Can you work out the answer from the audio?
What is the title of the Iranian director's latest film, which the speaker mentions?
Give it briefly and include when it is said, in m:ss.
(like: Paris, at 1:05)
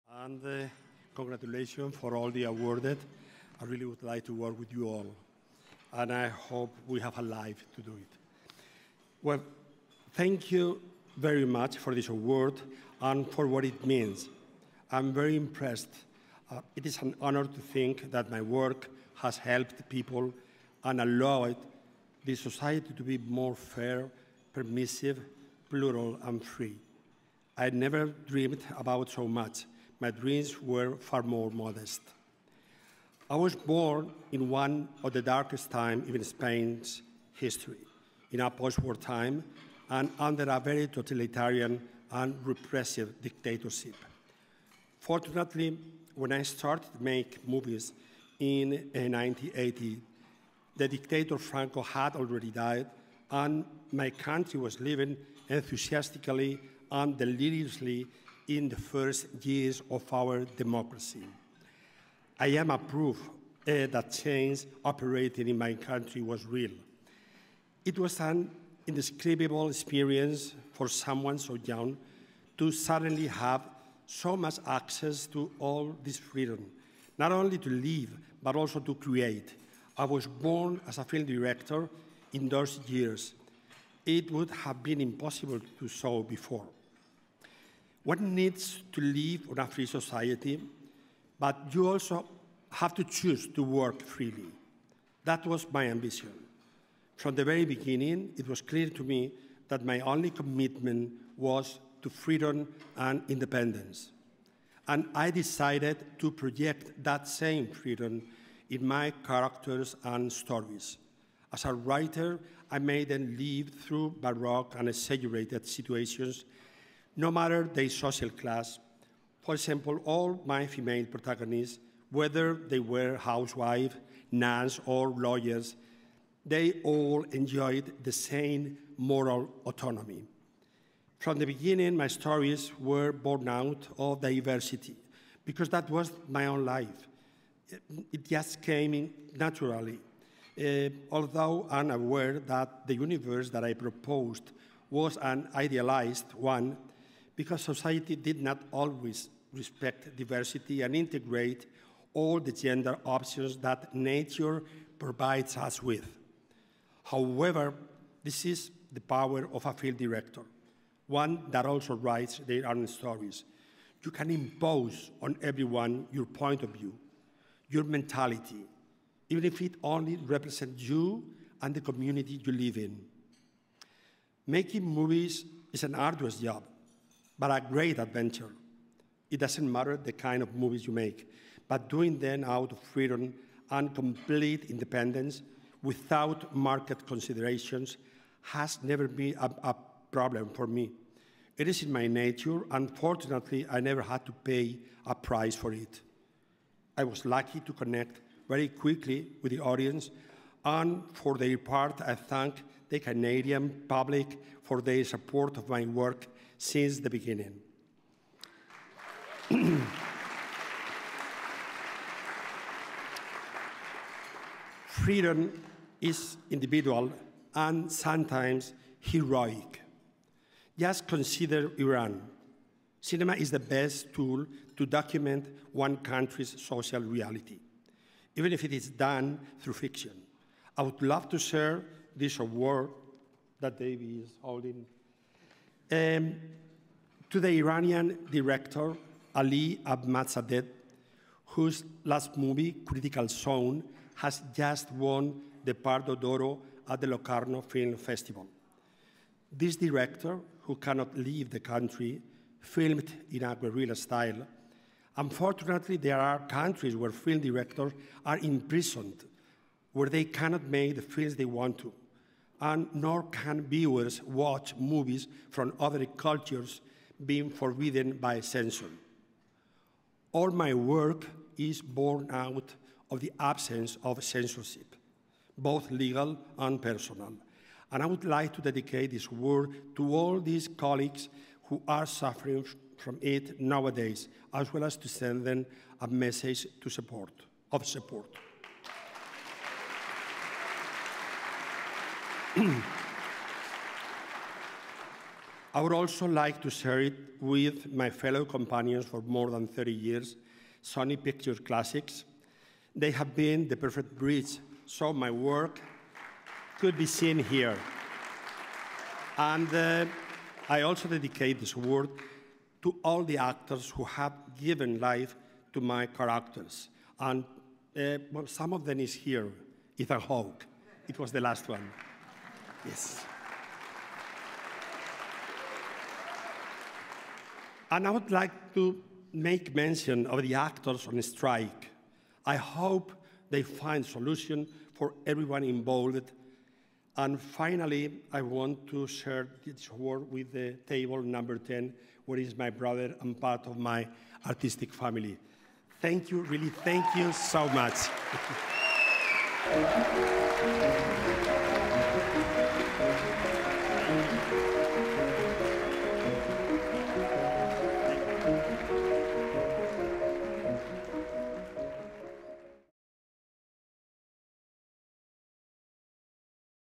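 Critical Zone, at 4:02.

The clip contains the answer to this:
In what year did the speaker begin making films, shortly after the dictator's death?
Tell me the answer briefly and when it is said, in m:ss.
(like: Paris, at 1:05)
1980, at 0:48.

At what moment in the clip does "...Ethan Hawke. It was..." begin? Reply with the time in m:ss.
5:19.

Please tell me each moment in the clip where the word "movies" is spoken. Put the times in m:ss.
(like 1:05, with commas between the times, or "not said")
0:47, 2:54, 3:00, 4:02, 4:24.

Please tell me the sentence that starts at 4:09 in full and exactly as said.
This director, who cannot leave the country, filmed in a guerrilla style.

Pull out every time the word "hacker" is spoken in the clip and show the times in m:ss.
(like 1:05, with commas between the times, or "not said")
not said.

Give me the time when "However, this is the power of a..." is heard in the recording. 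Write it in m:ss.
2:37.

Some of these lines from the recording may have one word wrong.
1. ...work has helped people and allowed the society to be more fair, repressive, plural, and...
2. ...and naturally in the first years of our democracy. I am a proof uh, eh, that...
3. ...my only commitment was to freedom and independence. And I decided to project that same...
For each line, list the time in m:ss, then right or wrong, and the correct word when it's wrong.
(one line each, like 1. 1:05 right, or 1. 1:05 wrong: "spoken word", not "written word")
1. 0:18 wrong: "permissive", not "repressive"
2. 0:56 wrong: "deliriously", not "naturally"
3. 1:39 right.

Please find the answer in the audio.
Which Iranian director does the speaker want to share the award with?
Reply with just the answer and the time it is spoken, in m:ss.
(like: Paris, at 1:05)
Ali Ahmadzadeh, at 3:59.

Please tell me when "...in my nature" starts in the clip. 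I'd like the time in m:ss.
3:11.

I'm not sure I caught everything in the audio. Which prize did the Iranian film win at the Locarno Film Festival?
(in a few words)
Pardo d'Oro.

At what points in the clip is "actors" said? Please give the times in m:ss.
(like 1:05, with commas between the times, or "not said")
5:13, 5:30.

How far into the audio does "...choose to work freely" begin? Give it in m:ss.
1:33.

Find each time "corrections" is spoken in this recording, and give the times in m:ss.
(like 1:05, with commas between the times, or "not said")
not said.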